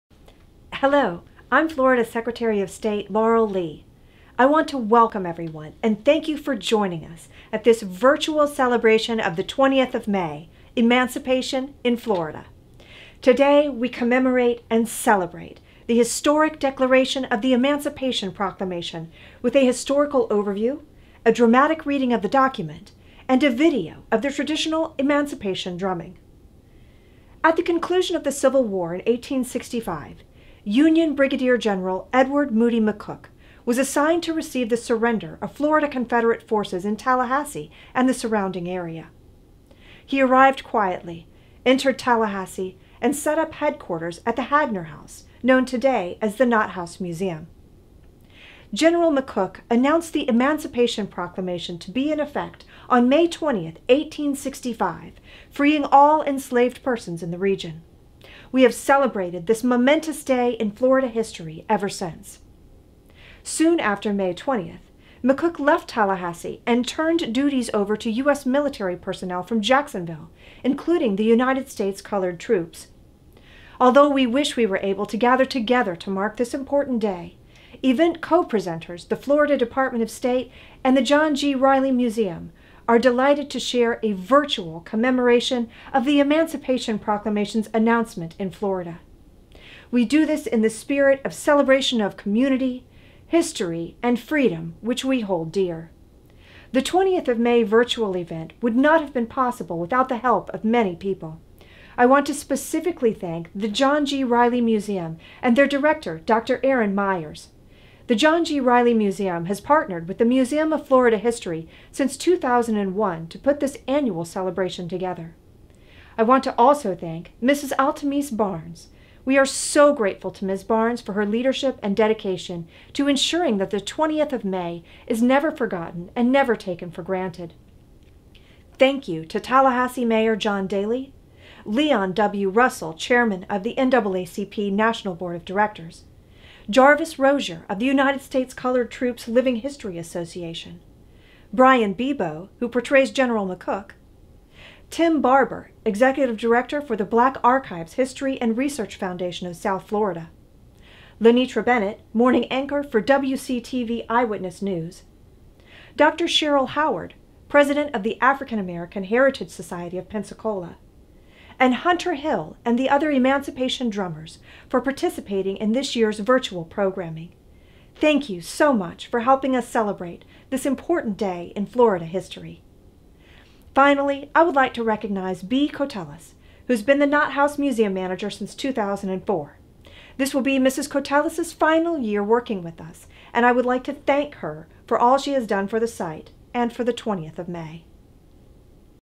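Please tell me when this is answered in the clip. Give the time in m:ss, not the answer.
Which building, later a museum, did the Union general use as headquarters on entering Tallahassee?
0:44.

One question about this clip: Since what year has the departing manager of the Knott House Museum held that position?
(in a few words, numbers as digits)
2004.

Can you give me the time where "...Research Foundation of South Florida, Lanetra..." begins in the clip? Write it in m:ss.
2:28.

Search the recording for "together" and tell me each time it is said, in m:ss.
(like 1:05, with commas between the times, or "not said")
1:15, 1:54.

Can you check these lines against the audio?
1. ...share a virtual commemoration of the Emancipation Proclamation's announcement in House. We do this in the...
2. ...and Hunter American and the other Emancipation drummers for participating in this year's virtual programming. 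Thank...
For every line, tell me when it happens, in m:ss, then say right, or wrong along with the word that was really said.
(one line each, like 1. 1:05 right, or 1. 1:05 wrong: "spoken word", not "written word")
1. 1:23 wrong: "Florida", not "House"
2. 2:41 wrong: "Hill", not "American".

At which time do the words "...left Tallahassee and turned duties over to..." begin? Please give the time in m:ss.
1:05.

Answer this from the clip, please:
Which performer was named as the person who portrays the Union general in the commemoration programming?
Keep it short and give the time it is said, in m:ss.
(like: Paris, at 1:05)
Brian Bebo, at 2:21.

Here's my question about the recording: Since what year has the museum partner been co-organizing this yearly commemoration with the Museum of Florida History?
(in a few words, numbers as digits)
2001.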